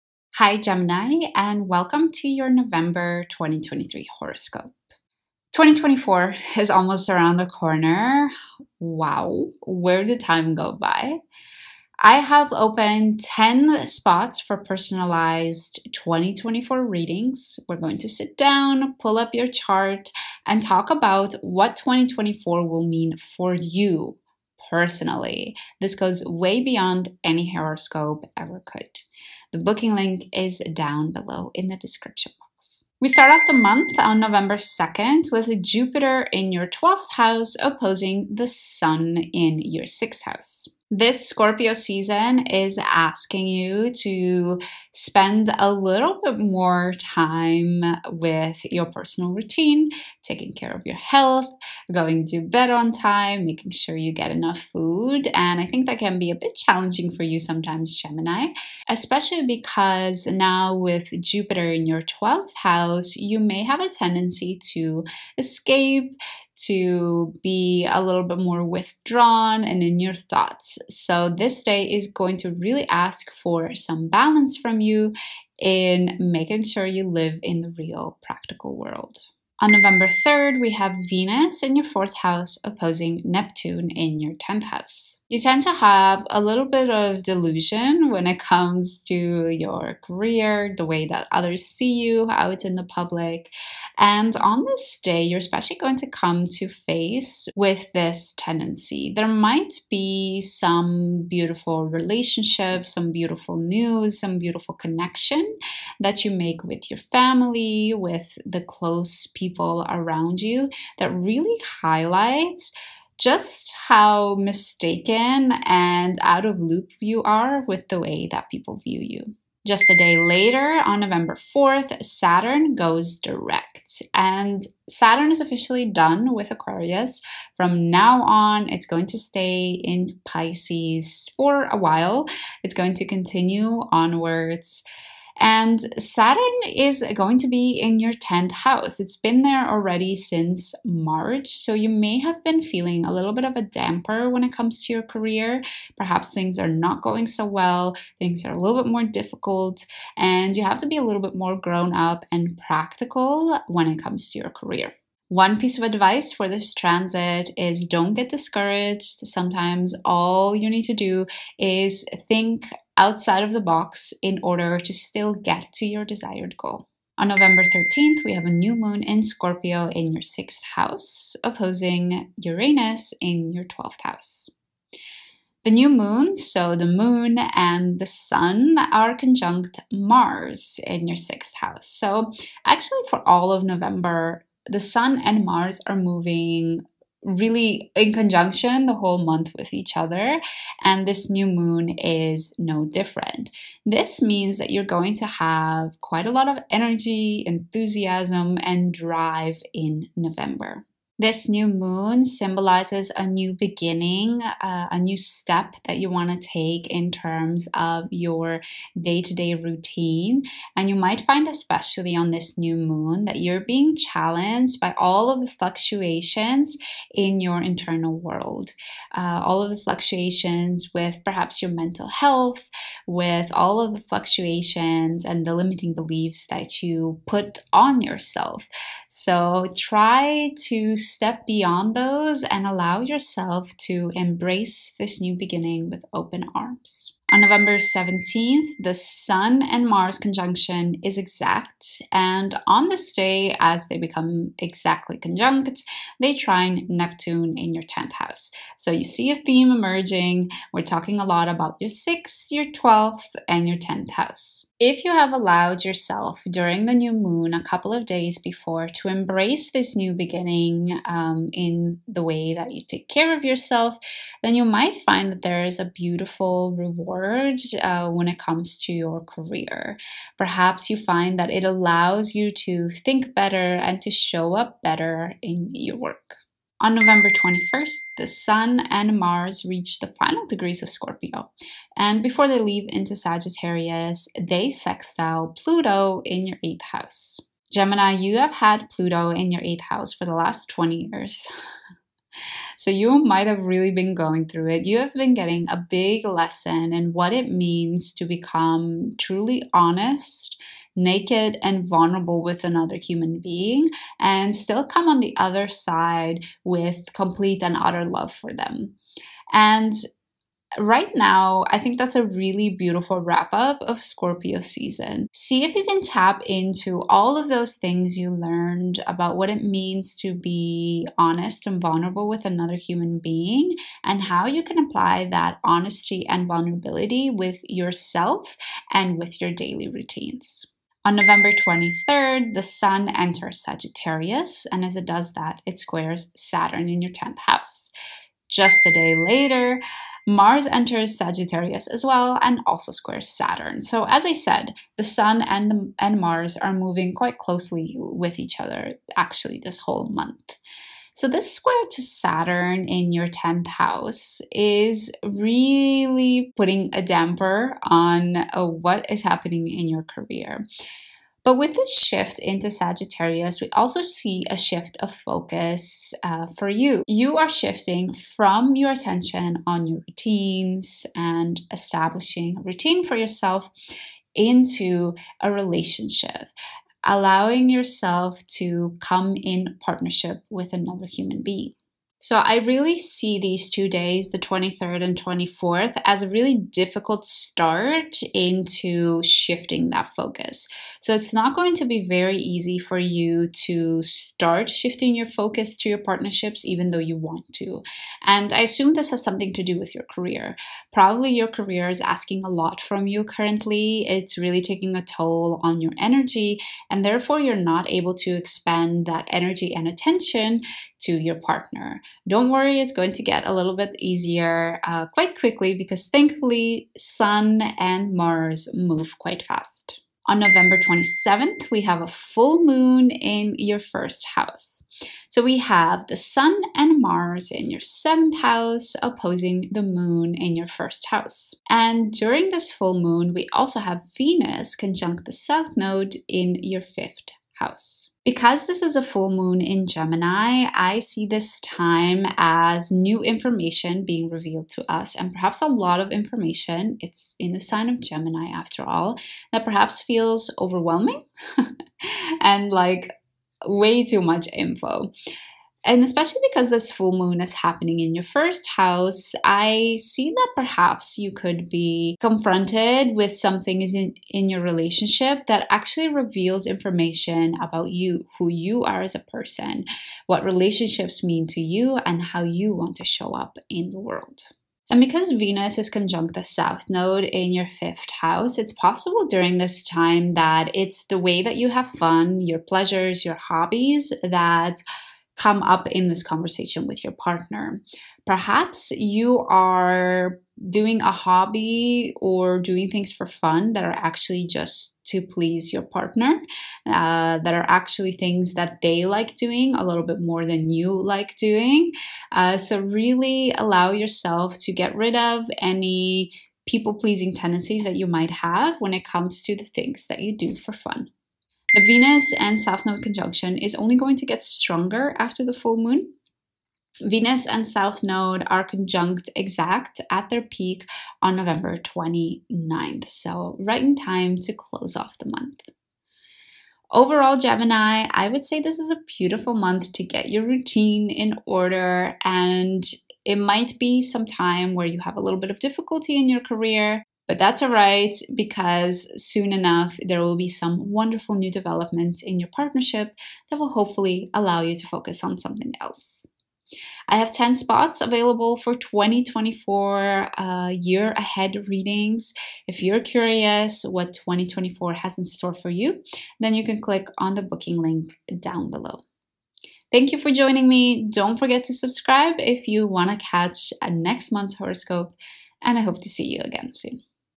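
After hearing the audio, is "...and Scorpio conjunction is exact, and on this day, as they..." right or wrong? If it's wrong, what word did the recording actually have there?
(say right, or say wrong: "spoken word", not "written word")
wrong: "Mars", not "Scorpio".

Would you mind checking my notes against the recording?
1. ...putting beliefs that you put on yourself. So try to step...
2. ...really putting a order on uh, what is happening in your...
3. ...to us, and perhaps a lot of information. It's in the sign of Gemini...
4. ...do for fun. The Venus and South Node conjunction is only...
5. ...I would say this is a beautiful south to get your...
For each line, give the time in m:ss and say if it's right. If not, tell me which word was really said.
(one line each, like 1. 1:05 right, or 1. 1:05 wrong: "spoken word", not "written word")
1. 3:45 wrong: "limiting", not "putting"
2. 5:55 wrong: "damper", not "order"
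3. 7:24 right
4. 8:30 right
5. 8:48 wrong: "month", not "south".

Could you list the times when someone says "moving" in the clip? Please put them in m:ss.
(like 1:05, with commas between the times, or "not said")
3:05, 5:46.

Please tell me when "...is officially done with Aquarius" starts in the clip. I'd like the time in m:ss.
2:05.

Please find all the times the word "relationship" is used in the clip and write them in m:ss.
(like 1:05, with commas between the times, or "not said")
1:41, 6:15, 7:44, 7:50.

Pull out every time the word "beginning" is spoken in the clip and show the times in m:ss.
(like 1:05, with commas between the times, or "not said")
3:23, 3:55, 4:20.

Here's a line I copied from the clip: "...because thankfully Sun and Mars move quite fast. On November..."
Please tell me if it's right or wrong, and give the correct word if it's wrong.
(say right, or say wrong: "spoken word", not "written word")
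right.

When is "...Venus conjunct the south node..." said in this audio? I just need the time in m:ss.
7:14.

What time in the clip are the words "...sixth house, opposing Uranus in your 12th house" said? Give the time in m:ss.
2:50.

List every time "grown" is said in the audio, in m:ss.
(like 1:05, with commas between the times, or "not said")
2:31.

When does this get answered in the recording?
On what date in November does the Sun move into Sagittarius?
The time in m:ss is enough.
5:31.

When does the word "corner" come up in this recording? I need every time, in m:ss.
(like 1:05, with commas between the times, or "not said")
0:07.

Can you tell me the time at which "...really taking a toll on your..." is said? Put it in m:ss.
6:44.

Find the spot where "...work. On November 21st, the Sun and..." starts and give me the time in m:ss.
4:35.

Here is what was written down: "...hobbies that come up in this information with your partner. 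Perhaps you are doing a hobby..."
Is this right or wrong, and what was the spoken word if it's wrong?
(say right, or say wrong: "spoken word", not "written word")
wrong: "conversation", not "information".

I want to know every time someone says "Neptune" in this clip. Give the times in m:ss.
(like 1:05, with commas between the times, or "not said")
1:23, 4:06.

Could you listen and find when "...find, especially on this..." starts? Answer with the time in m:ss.
3:31.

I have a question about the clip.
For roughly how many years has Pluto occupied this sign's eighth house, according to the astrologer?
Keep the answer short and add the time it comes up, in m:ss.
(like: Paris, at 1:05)
20, at 4:50.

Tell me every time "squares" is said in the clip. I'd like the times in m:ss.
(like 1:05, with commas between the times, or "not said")
5:35, 5:42, 5:51.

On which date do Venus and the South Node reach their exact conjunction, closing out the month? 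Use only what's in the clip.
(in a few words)
November 29.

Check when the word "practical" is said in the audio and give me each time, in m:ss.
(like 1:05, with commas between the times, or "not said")
1:18, 2:32.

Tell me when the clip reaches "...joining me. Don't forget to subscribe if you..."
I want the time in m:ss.
9:20.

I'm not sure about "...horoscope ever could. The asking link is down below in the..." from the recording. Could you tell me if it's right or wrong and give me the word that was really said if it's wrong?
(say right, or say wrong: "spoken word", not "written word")
wrong: "booking", not "asking".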